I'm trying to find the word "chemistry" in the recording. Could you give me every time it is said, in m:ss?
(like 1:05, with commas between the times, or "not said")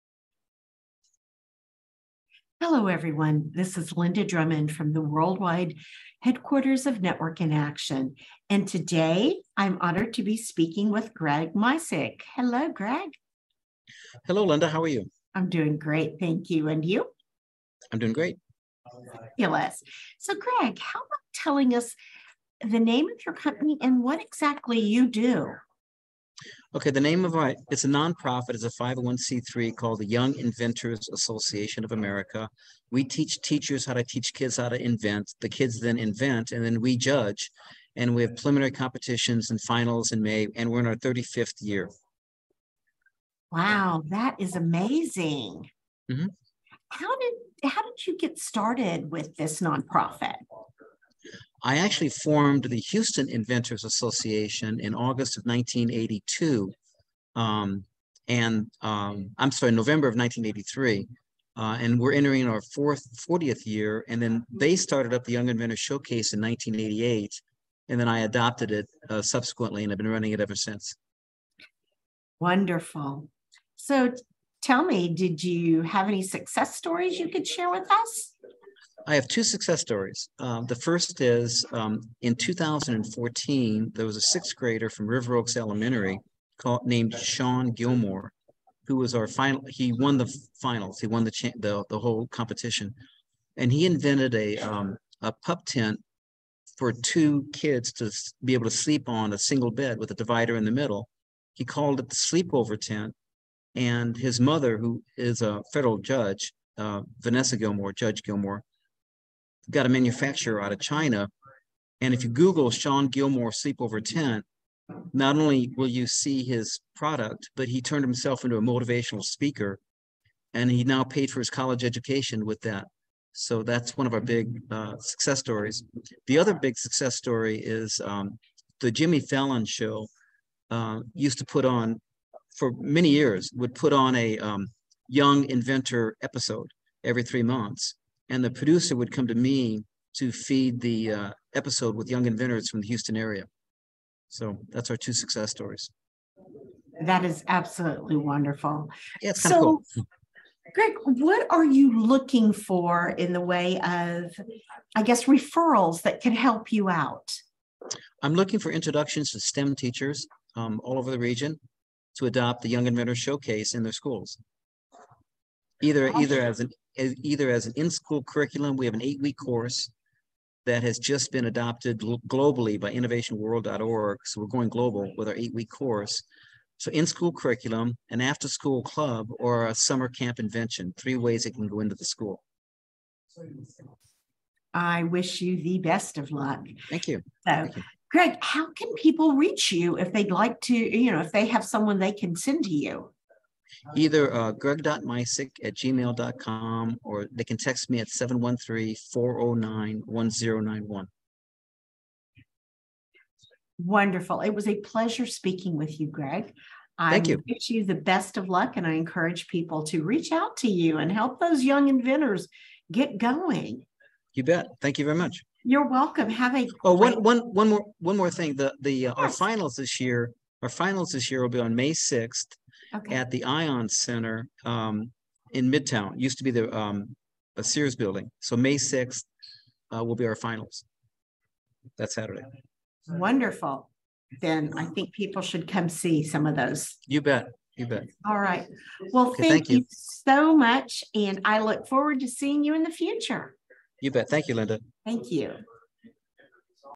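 not said.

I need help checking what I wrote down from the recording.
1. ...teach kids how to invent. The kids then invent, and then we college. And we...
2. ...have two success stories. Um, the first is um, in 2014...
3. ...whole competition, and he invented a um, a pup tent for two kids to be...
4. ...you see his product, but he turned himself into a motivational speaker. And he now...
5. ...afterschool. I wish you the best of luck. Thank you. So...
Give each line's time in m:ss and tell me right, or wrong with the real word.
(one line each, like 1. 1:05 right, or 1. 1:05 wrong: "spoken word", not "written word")
1. 0:34 wrong: "judge", not "college"
2. 1:19 right
3. 1:31 right
4. 1:55 right
5. 3:02 wrong: "school", not "afterschool".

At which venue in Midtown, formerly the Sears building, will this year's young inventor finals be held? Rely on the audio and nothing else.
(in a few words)
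Ion Center.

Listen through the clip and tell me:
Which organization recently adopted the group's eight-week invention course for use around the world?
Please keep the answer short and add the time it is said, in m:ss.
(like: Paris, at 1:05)
innovationworld.org, at 2:52.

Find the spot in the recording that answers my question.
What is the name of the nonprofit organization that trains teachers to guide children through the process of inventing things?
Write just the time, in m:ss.
0:30.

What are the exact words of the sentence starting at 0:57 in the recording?
Um, and um, I'm sorry, November of 1983.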